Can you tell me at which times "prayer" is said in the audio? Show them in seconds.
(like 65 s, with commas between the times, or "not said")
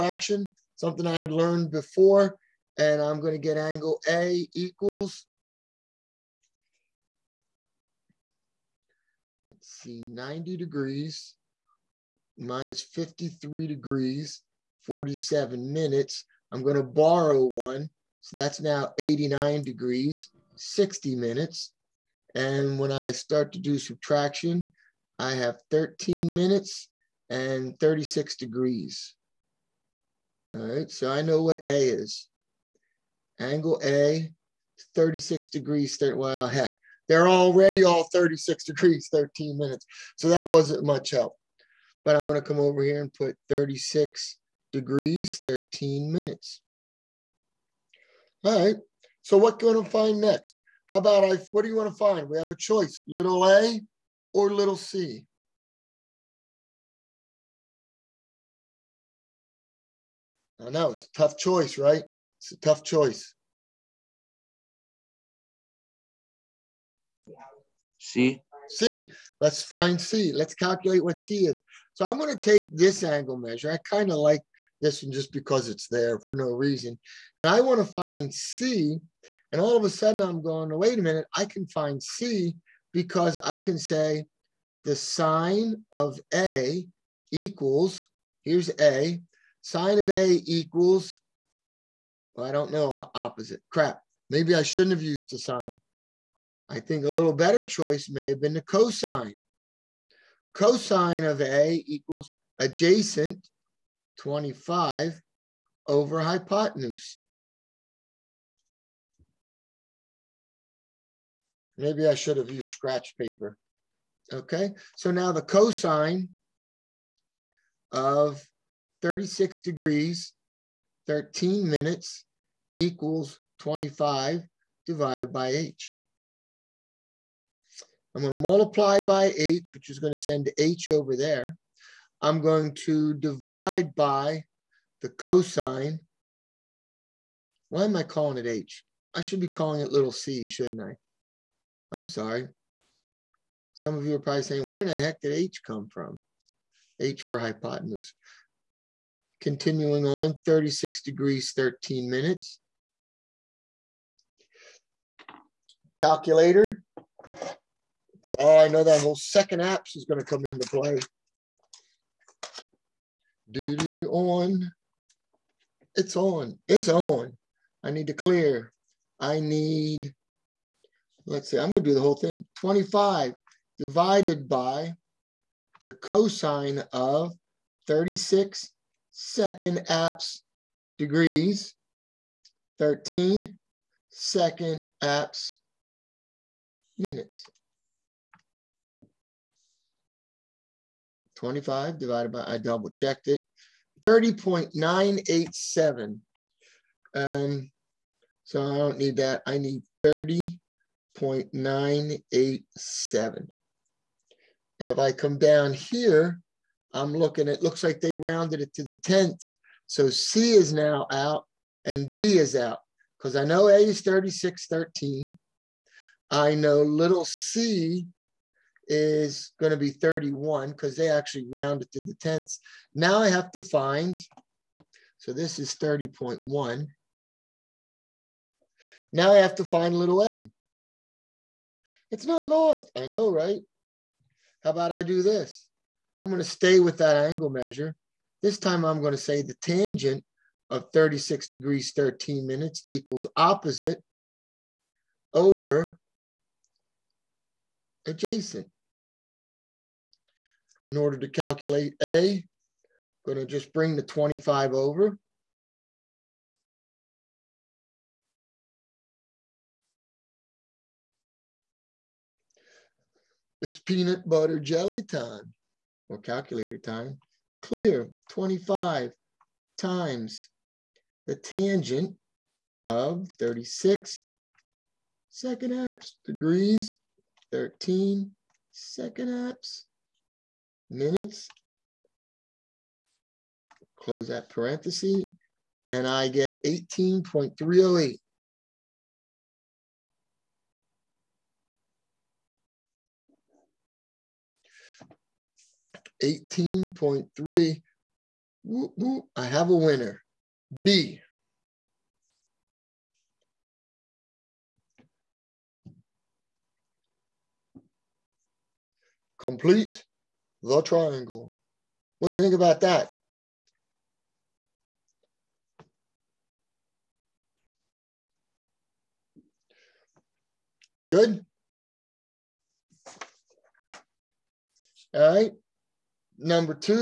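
not said.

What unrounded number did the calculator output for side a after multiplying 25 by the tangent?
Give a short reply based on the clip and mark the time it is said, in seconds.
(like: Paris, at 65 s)
18.308, at 286 s.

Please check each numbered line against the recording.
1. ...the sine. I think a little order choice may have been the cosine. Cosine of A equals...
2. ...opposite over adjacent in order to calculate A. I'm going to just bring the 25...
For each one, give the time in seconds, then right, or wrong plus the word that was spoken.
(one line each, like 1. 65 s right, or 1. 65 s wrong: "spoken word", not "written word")
1. 95 s wrong: "better", not "order"
2. 243 s right.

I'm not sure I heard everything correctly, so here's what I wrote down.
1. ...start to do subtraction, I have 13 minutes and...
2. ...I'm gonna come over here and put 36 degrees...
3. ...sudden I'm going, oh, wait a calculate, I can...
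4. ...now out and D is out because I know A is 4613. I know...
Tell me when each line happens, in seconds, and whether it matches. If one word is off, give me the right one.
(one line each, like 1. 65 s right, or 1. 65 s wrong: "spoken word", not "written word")
1. 23 s right
2. 42 s right
3. 79 s wrong: "minute", not "calculate"
4. 210 s wrong: "3613", not "4613".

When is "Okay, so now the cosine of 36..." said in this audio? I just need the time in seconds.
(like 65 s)
114 s.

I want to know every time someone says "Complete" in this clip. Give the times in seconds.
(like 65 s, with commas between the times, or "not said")
309 s.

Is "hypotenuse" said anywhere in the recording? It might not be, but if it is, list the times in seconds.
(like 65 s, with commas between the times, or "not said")
106 s, 147 s.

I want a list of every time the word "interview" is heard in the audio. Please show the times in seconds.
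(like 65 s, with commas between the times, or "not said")
not said.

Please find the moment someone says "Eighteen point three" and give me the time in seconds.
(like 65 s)
296 s.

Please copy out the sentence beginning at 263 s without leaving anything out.
It's peanut butter jelly time or calculator time.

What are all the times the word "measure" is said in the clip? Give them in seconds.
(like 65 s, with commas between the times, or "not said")
73 s, 237 s.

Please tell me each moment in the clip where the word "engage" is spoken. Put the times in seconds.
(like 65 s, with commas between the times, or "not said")
not said.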